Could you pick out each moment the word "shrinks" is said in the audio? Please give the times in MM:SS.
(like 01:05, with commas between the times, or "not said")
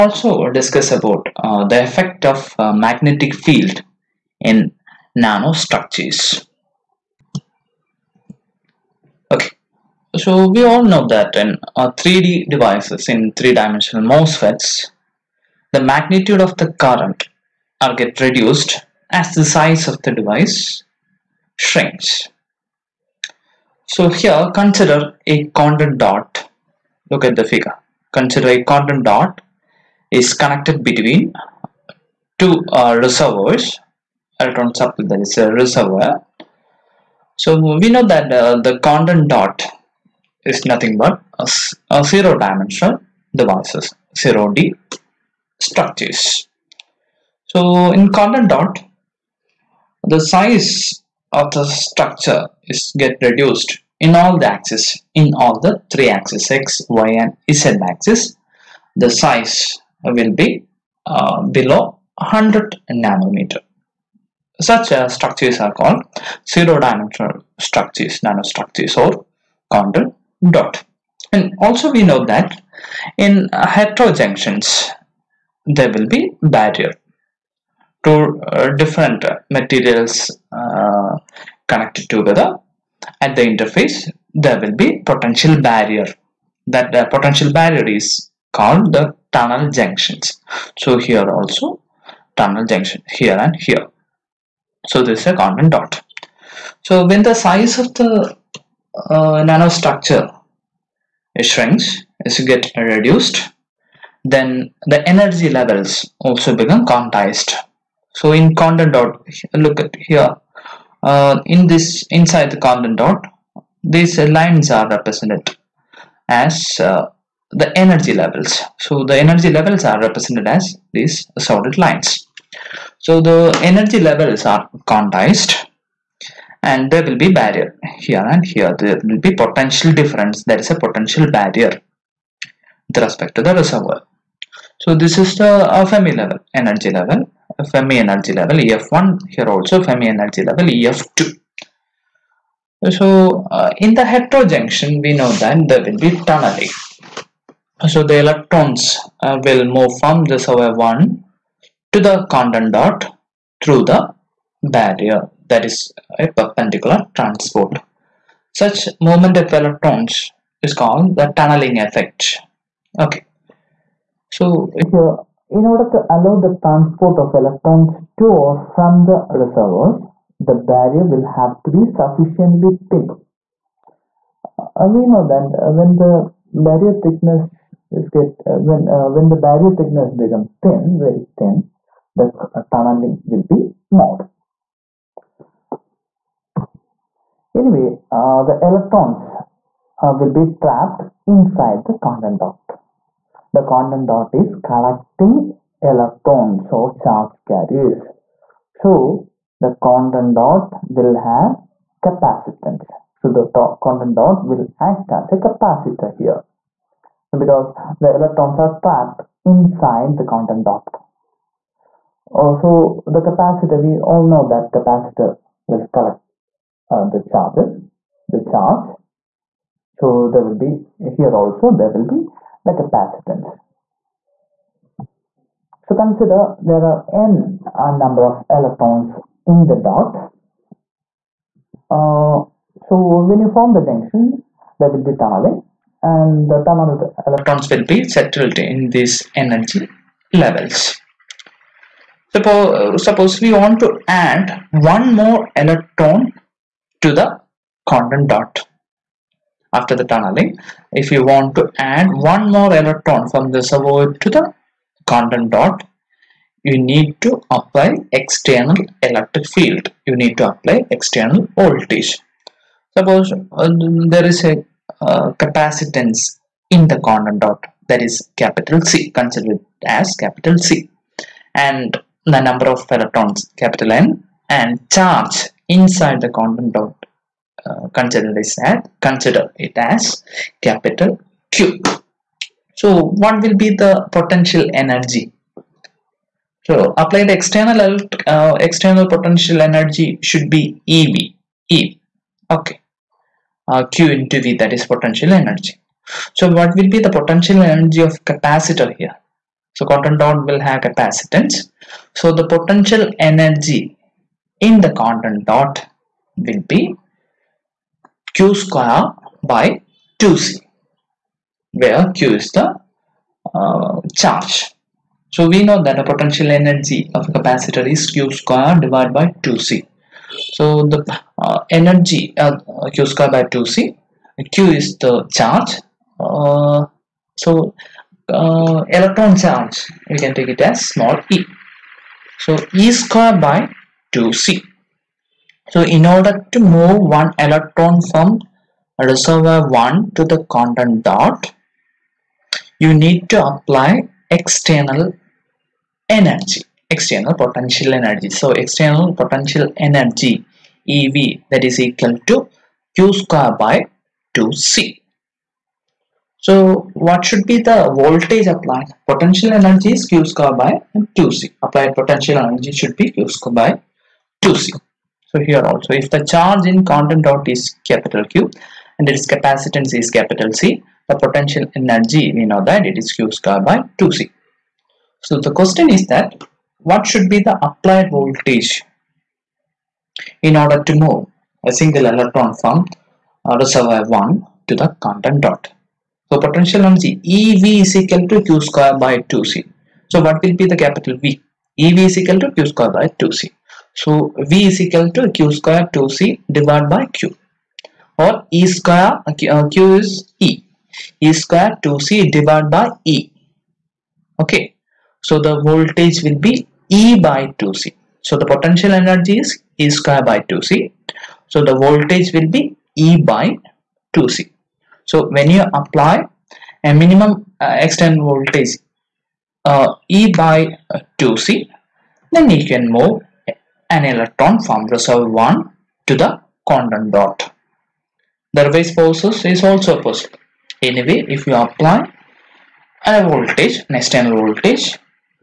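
00:21, 01:41.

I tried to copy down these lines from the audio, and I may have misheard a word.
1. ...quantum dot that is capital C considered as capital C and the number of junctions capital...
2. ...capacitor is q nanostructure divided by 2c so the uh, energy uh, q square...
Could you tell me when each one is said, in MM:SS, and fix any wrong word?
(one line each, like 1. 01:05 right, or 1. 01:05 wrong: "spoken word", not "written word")
1. 04:27 wrong: "electrons", not "junctions"
2. 05:17 wrong: "square", not "nanostructure".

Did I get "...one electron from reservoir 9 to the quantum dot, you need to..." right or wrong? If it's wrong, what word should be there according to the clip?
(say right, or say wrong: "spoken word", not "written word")
wrong: "1", not "9".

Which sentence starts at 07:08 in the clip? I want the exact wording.
The reverse process is also possible.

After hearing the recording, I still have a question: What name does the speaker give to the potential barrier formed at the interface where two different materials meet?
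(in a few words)
tunnel junctions.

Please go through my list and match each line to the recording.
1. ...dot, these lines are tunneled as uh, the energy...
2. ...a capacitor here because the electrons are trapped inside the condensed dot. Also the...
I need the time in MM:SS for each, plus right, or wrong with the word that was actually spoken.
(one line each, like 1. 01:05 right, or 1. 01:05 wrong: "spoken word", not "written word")
1. 01:52 wrong: "represented", not "tunneled"
2. 03:25 right.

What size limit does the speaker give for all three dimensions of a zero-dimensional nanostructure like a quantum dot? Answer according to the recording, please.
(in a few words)
below 100 nanometers.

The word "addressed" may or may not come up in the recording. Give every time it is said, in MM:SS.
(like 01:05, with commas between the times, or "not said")
not said.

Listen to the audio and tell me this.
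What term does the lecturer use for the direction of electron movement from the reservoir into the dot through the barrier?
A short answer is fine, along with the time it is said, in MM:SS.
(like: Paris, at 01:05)
perpendicular transport, at 02:36.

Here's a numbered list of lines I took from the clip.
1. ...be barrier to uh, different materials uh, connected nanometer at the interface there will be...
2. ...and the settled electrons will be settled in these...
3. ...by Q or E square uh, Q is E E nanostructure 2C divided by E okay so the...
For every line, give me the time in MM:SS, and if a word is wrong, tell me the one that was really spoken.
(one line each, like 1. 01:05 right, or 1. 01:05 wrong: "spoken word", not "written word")
1. 01:16 wrong: "together", not "nanometer"
2. 03:56 wrong: "tunneled", not "settled"
3. 06:36 wrong: "square", not "nanostructure".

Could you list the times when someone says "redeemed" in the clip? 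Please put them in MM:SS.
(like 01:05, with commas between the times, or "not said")
not said.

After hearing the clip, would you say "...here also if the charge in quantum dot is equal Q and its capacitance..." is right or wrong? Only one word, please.
wrong.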